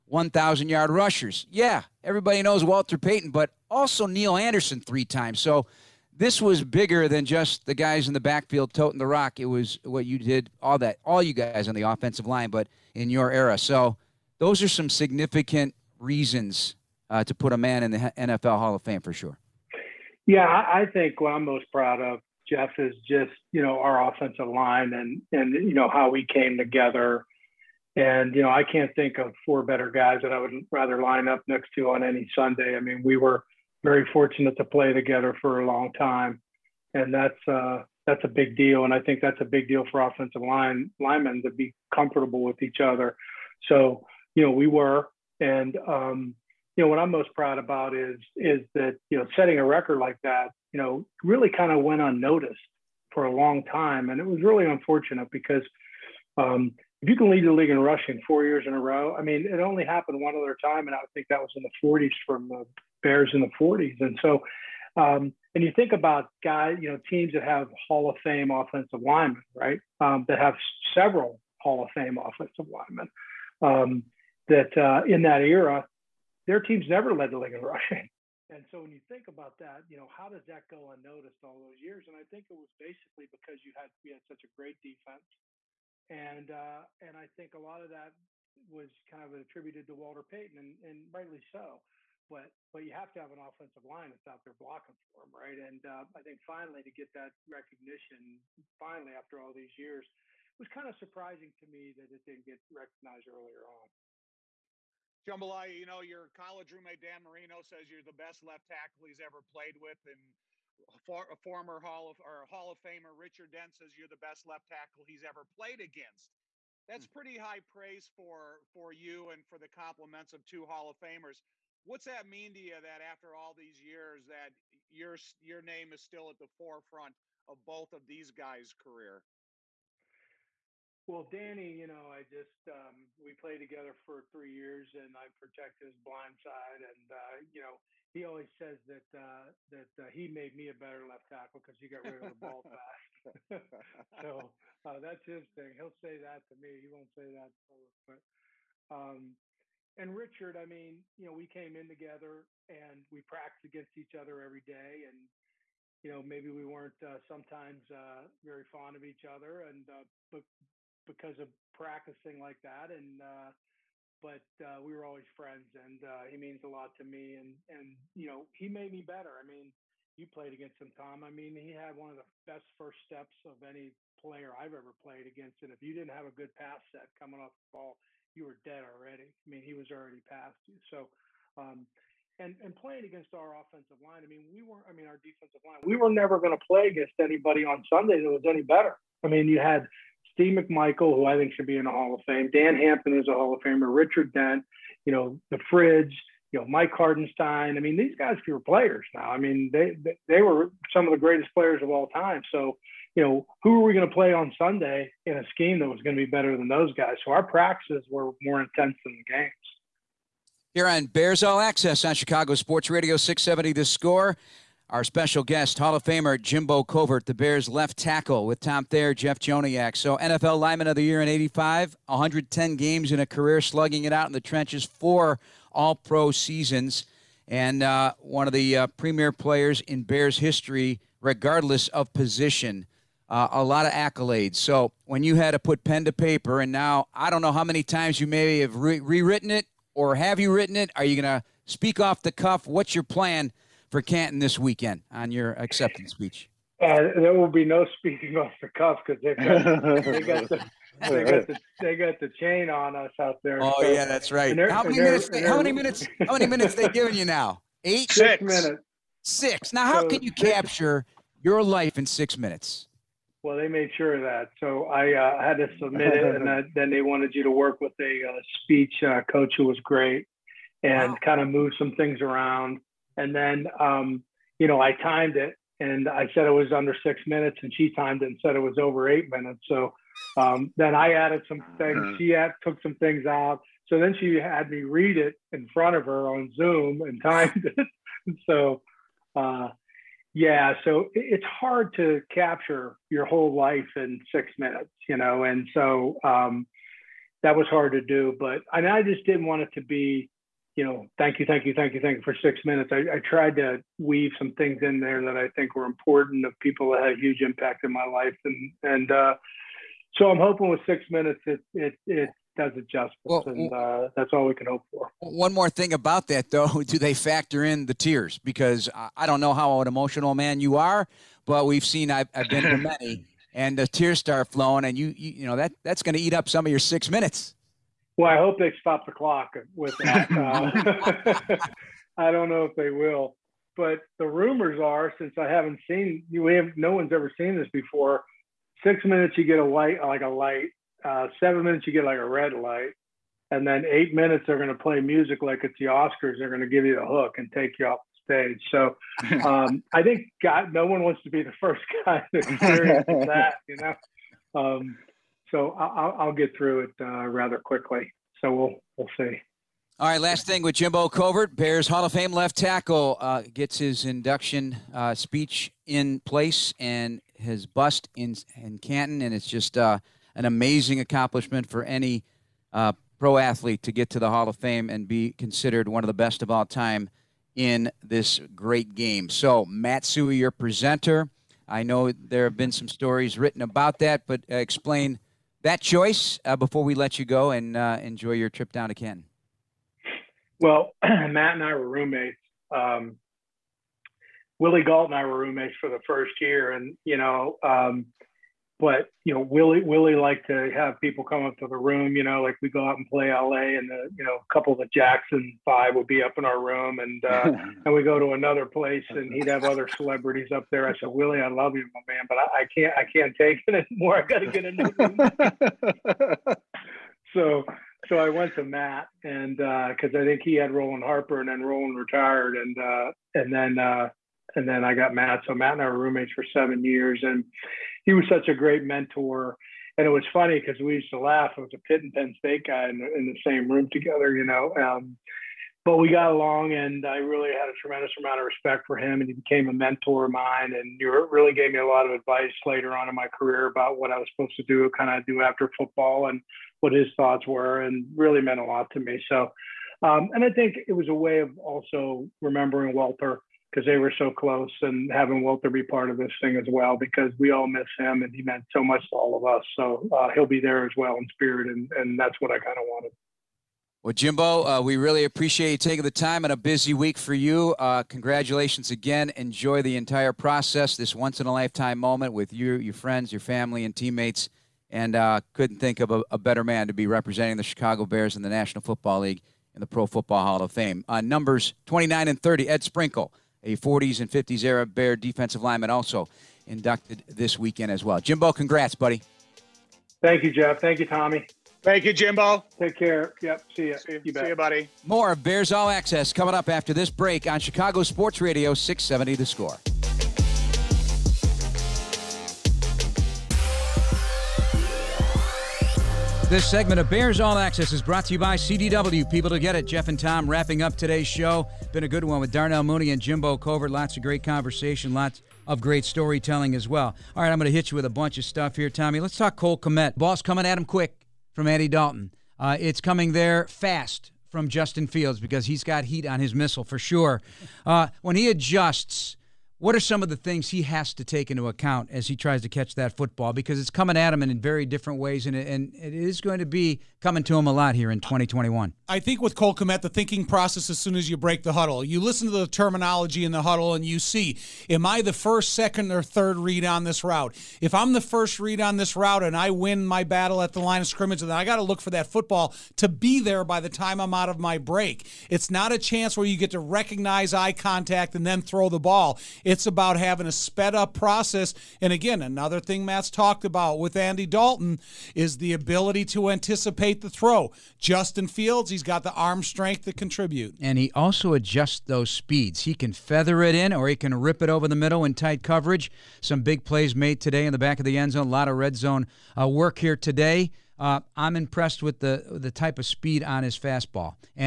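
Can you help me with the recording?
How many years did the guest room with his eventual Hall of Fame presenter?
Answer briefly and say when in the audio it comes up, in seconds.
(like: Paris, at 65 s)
7, at 426 s.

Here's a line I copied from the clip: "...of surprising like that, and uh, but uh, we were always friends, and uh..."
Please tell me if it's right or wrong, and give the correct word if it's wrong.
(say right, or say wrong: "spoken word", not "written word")
wrong: "practicing", not "surprising".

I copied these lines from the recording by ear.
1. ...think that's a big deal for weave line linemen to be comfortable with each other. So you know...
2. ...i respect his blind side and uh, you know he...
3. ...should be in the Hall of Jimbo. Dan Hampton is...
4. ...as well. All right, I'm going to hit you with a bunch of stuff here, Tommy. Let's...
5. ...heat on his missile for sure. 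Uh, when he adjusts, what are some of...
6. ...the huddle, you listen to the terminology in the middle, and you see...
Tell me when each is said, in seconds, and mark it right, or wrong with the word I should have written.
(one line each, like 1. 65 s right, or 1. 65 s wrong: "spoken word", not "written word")
1. 38 s wrong: "offensive", not "weave"
2. 135 s wrong: "protect", not "respect"
3. 191 s wrong: "Fame", not "Jimbo"
4. 516 s right
5. 526 s right
6. 541 s wrong: "huddle", not "middle".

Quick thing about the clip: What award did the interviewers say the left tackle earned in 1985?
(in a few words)
NFL lineman of the year.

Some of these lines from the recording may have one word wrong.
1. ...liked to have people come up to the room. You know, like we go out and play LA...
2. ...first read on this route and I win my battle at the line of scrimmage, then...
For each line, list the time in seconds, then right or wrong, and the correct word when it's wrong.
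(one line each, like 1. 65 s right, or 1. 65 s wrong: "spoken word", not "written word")
1. 400 s right
2. 548 s right.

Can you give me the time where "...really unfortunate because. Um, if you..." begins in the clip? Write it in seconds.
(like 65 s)
54 s.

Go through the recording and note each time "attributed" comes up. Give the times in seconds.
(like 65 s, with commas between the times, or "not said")
89 s.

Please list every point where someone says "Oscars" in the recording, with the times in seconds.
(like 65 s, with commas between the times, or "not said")
345 s.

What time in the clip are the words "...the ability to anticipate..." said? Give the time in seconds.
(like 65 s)
565 s.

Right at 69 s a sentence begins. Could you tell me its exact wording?
Um, that have several Hall of Fame offensive linemen.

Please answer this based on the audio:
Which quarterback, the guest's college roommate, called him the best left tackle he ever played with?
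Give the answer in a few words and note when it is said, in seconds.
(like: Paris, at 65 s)
Dan Marino, at 106 s.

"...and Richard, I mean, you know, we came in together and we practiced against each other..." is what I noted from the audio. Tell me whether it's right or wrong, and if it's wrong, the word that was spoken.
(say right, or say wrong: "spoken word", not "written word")
right.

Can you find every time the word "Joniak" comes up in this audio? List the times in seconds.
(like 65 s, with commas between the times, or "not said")
219 s.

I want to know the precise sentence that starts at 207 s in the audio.
So our practices were more intense than the games.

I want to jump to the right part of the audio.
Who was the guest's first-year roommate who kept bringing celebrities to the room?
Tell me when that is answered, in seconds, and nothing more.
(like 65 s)
394 s.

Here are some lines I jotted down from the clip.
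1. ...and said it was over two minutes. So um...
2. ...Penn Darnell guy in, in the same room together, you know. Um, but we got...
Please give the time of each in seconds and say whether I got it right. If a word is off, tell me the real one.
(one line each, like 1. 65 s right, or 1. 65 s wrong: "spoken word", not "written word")
1. 278 s wrong: "eight", not "two"
2. 432 s wrong: "State", not "Darnell".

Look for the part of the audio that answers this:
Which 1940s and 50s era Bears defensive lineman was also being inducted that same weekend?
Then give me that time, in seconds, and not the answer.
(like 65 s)
482 s.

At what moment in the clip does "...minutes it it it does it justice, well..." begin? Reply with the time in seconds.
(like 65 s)
311 s.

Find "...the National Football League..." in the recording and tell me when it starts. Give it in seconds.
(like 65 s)
478 s.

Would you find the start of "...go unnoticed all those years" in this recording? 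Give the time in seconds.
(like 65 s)
80 s.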